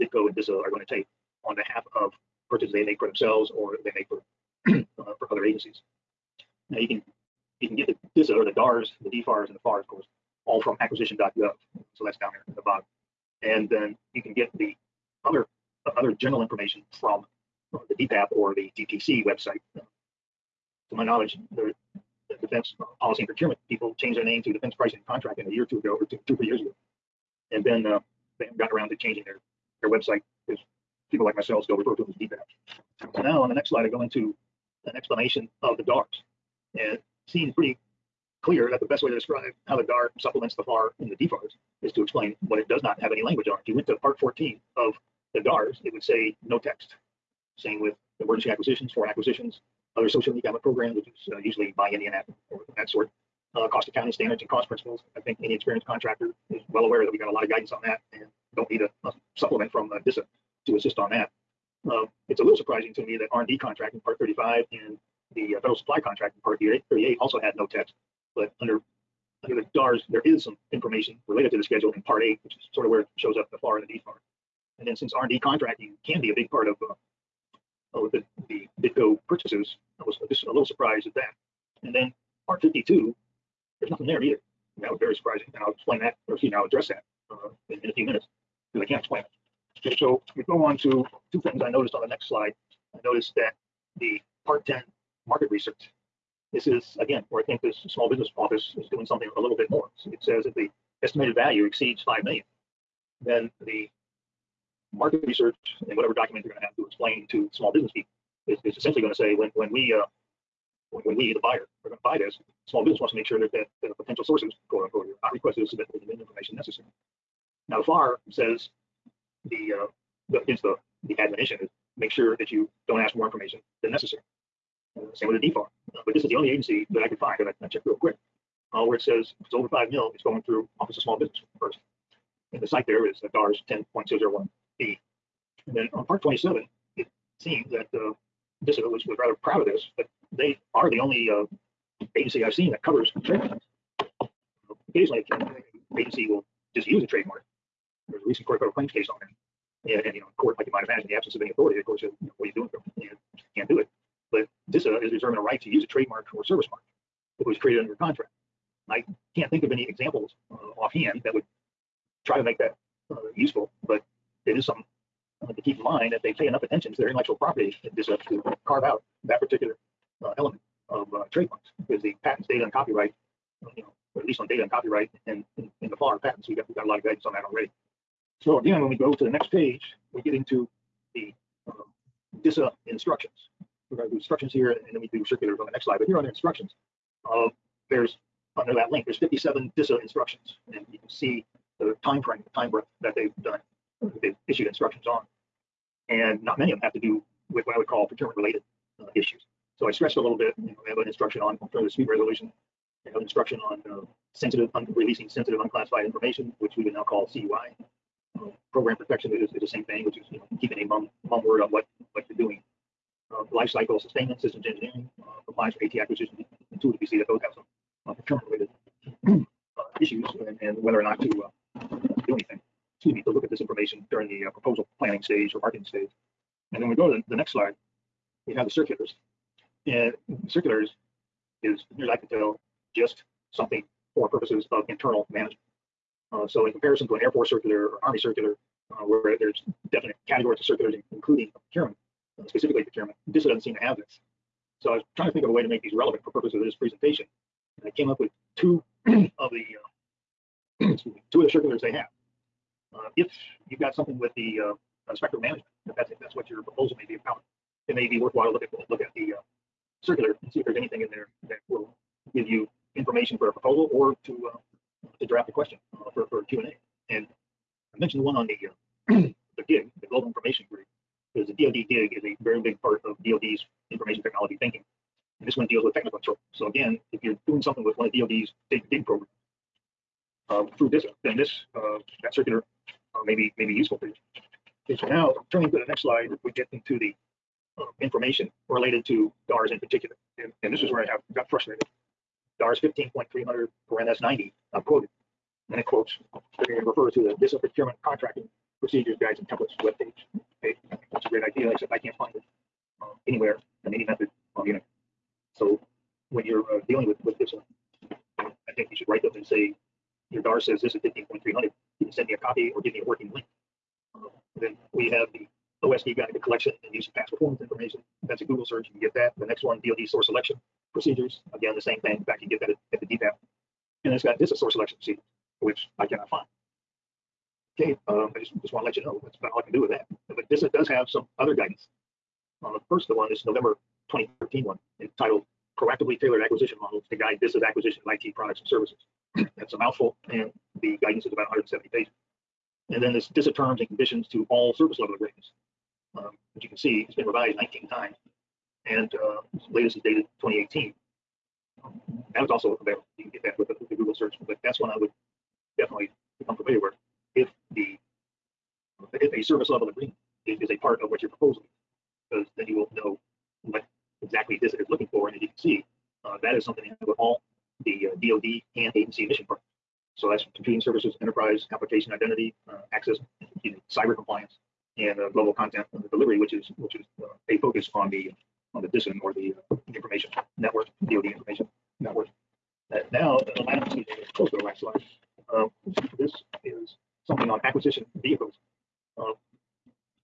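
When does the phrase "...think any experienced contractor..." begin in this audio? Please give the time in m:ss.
0:55.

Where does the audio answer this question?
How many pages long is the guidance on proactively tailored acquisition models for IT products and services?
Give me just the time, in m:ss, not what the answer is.
5:41.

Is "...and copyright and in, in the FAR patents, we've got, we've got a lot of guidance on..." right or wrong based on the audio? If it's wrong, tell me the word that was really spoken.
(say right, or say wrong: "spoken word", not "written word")
right.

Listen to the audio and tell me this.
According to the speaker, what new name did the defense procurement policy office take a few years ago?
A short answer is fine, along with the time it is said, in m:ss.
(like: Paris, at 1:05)
Defense Pricing Contracting, at 0:24.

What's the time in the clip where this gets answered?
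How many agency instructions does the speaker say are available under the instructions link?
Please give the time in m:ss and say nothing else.
3:09.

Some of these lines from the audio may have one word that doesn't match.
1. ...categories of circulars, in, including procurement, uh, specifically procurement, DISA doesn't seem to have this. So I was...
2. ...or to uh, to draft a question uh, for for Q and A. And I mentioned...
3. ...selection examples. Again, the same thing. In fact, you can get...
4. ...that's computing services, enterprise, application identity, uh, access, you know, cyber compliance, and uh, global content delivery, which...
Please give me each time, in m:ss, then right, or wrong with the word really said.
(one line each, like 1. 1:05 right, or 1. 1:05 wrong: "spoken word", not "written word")
1. 4:00 right
2. 4:23 right
3. 5:20 wrong: "procedures", not "examples"
4. 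6:10 right.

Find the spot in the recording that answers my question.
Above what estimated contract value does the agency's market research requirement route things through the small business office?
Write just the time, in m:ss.
1:41.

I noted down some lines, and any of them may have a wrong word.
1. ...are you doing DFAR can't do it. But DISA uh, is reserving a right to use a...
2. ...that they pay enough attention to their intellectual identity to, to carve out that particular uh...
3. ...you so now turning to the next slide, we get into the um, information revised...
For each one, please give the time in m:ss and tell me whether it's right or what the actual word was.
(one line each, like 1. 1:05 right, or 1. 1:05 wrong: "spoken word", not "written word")
1. 2:32 wrong: "And", not "DFAR"
2. 2:46 wrong: "property", not "identity"
3. 4:44 wrong: "related", not "revised".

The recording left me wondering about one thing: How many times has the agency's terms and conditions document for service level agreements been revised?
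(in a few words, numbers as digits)
19 times.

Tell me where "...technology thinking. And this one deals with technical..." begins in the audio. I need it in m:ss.
4:34.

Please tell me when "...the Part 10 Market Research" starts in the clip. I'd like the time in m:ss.
1:33.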